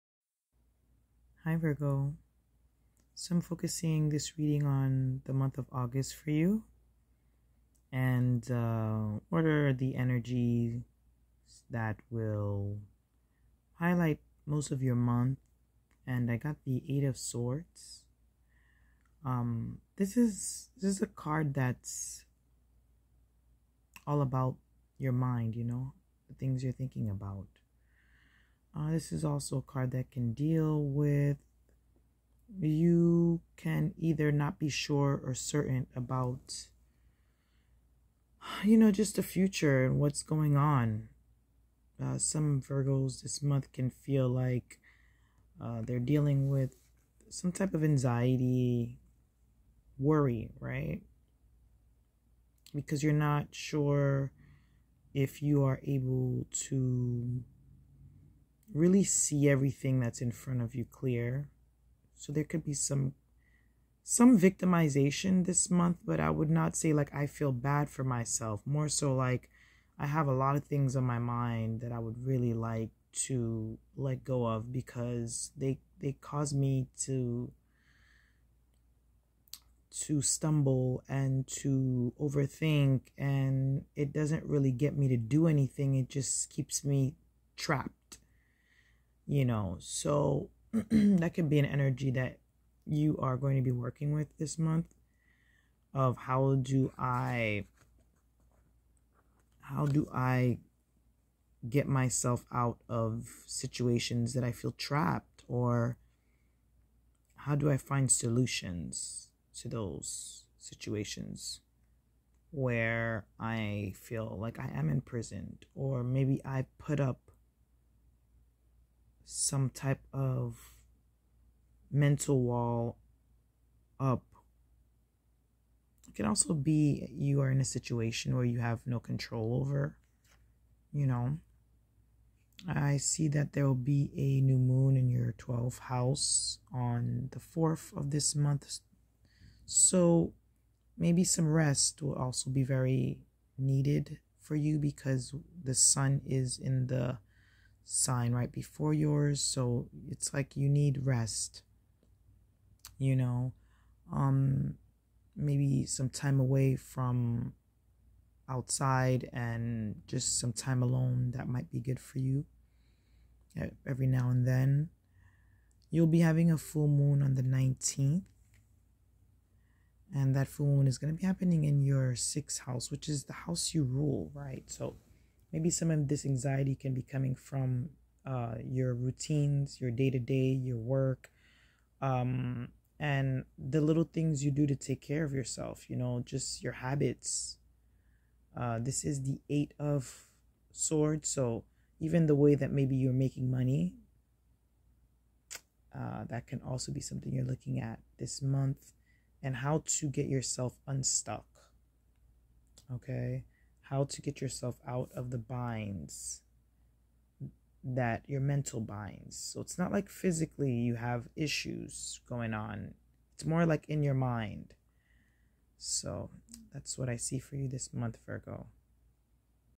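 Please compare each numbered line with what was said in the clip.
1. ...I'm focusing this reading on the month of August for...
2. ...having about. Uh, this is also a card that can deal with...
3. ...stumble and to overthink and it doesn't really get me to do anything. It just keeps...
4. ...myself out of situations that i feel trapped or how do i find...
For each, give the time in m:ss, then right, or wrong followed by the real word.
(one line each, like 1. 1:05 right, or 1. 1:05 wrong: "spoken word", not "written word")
1. 0:03 right
2. 0:26 wrong: "thinking", not "having"
3. 1:20 right
4. 1:41 right.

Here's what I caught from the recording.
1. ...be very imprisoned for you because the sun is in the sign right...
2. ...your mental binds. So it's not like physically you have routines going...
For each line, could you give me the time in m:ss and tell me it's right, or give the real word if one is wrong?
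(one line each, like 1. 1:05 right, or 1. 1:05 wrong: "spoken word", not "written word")
1. 2:22 wrong: "needed", not "imprisoned"
2. 3:28 wrong: "issues", not "routines".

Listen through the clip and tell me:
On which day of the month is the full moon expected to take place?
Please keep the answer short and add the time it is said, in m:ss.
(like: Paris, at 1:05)
19th, at 2:47.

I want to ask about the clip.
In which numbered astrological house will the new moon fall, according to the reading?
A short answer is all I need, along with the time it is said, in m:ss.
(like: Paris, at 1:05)
12th house, at 2:15.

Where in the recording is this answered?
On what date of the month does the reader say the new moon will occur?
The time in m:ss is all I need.
2:17.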